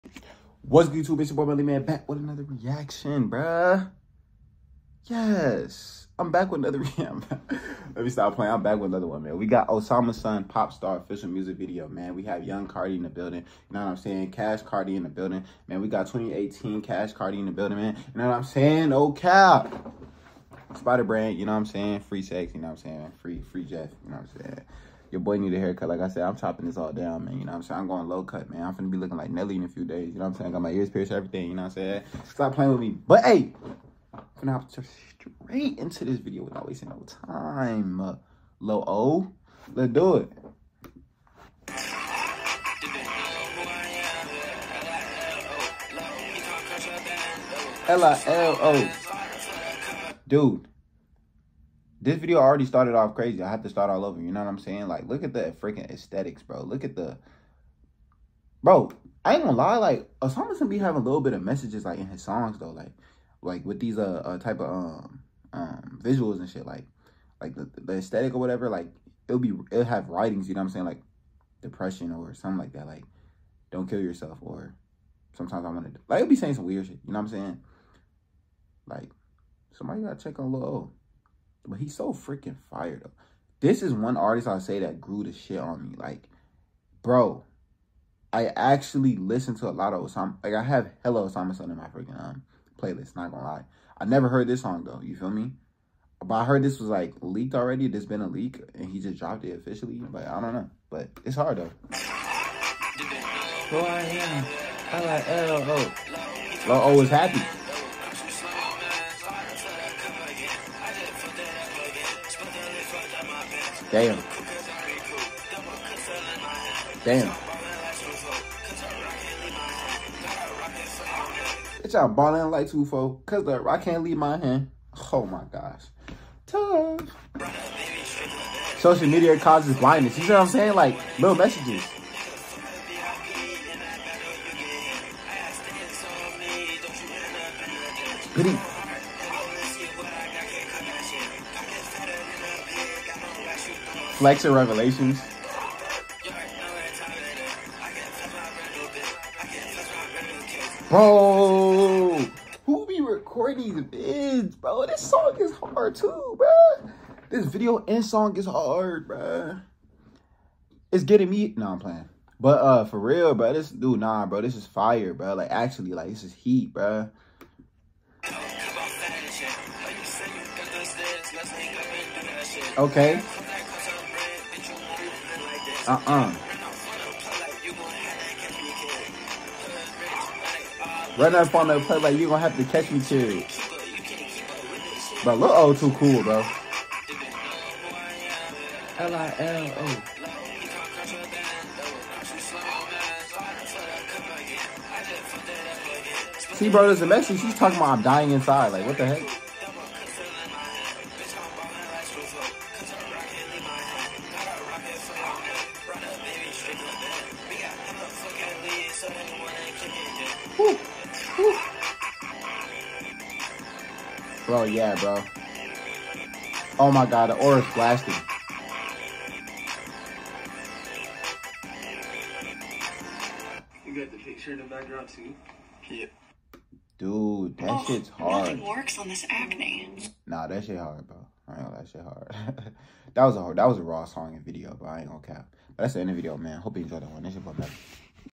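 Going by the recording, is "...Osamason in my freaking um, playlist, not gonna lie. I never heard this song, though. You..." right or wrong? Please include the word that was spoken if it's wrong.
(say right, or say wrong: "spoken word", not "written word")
right.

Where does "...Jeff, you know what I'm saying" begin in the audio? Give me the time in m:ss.
0:23.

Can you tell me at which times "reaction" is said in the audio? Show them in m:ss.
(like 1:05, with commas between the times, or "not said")
0:02, 0:06.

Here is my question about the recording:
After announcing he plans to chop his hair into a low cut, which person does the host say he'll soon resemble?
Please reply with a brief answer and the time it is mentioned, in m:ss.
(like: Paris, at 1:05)
Nelly, at 0:29.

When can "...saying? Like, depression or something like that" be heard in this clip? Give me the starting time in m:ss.
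1:10.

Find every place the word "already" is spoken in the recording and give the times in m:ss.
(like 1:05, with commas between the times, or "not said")
0:52, 1:37.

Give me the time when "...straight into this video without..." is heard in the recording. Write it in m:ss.
0:34.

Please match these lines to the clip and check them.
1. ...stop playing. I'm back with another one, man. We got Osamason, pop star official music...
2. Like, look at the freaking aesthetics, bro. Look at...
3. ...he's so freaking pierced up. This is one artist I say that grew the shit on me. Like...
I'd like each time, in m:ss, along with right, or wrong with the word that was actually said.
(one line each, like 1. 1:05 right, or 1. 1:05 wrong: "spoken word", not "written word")
1. 0:08 right
2. 0:54 right
3. 1:21 wrong: "fired", not "pierced".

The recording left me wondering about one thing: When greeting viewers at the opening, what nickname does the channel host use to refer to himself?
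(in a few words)
Melly Man.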